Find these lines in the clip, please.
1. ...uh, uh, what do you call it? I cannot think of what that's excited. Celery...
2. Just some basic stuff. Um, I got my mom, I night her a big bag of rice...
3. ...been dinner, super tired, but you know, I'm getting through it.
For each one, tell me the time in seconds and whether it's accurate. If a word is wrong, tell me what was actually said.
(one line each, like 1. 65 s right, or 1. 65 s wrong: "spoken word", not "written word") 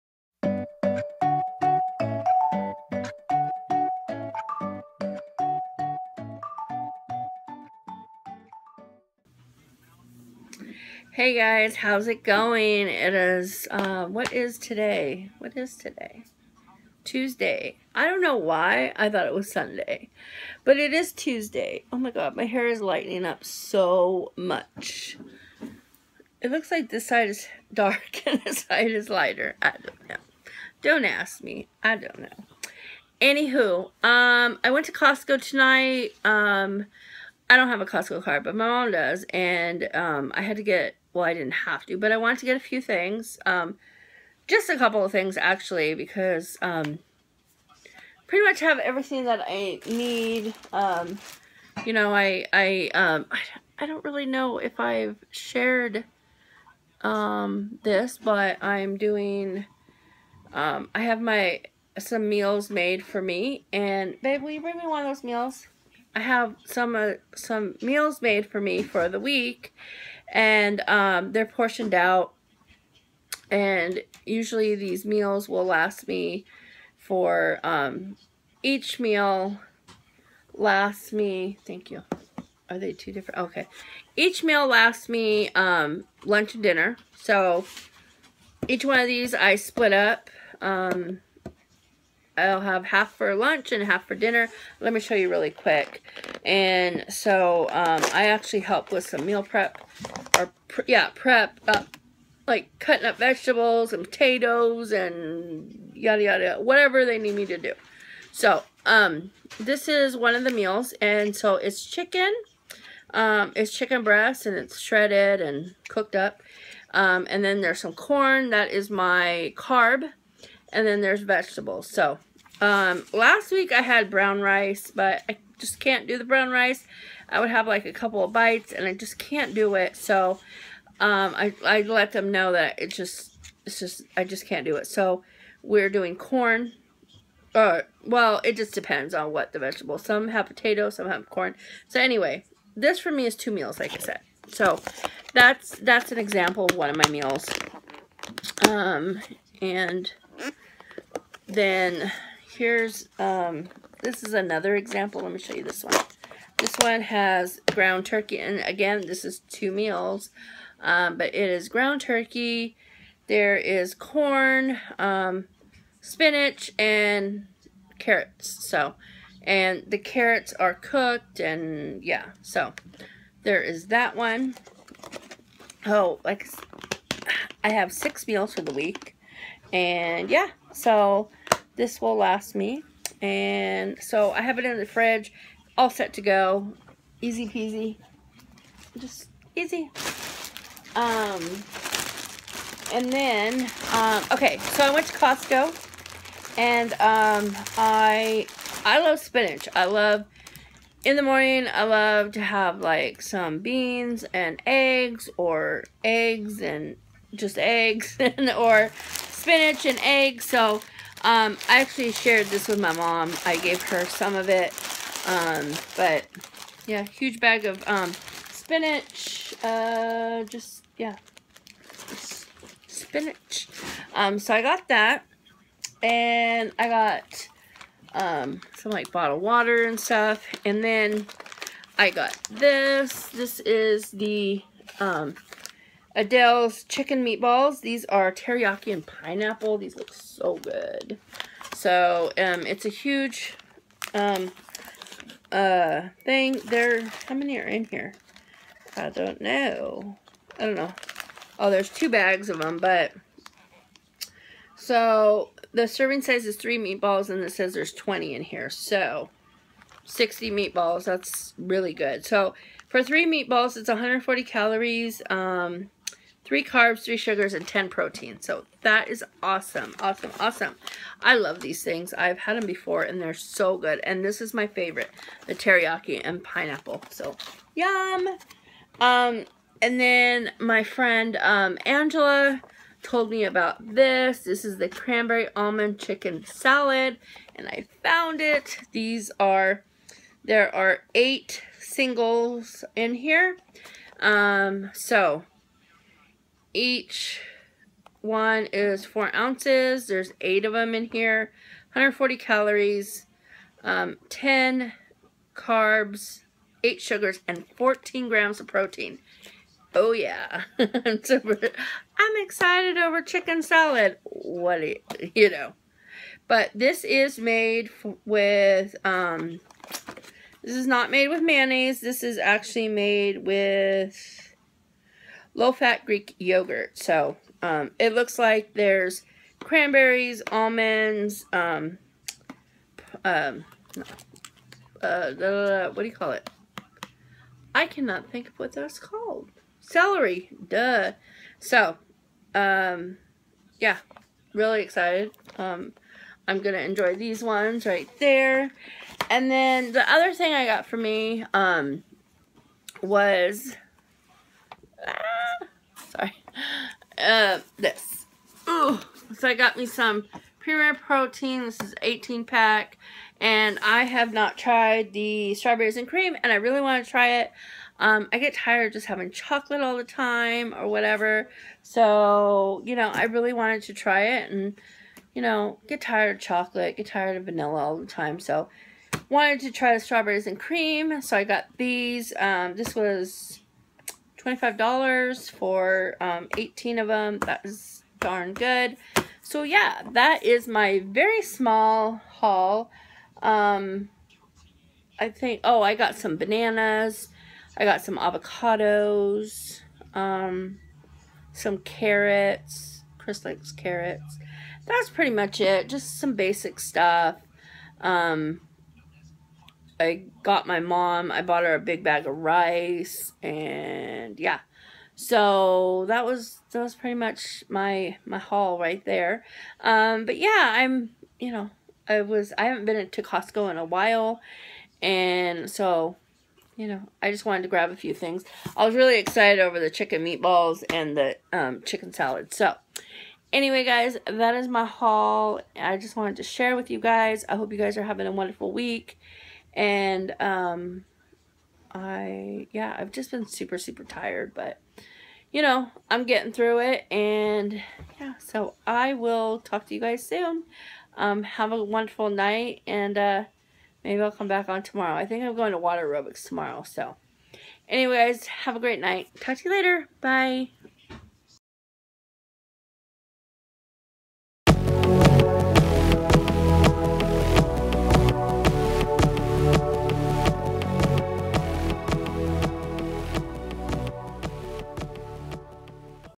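1. 335 s wrong: "called", not "excited"
2. 405 s wrong: "bought", not "night"
3. 443 s wrong: "super", not "dinner".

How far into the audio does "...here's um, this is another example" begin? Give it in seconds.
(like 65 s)
152 s.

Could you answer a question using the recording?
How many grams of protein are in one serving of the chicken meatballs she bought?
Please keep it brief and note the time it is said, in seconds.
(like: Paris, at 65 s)
10, at 267 s.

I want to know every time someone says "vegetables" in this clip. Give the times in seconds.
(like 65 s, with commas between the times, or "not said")
103 s, 121 s, 139 s.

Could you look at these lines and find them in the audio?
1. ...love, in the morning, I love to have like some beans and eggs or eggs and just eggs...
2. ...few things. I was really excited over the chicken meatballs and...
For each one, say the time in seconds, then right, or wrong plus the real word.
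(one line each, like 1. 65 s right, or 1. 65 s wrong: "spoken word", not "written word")
1. 199 s right
2. 427 s right.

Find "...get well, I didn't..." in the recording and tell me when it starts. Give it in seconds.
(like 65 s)
40 s.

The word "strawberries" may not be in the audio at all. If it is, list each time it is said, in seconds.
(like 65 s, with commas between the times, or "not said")
365 s, 379 s.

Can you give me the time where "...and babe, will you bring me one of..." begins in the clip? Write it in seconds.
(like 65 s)
63 s.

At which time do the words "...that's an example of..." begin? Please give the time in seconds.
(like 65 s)
145 s.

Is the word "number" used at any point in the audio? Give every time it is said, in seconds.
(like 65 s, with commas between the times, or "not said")
not said.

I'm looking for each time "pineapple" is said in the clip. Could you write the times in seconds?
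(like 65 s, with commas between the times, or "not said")
239 s, 276 s.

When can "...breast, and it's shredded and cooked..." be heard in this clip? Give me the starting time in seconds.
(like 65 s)
114 s.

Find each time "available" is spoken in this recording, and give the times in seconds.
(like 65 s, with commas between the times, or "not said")
not said.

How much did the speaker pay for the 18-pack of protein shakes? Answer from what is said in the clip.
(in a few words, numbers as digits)
$25.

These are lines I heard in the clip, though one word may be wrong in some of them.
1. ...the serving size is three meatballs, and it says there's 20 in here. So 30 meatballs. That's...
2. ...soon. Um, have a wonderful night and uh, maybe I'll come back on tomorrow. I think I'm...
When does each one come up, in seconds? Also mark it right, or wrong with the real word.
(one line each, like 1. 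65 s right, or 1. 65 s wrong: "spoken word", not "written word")
1. 255 s wrong: "60", not "30"
2. 450 s right.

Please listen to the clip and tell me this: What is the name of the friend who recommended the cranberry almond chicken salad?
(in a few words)
Angela.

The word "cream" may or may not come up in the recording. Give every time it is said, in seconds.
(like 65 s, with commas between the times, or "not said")
366 s, 380 s.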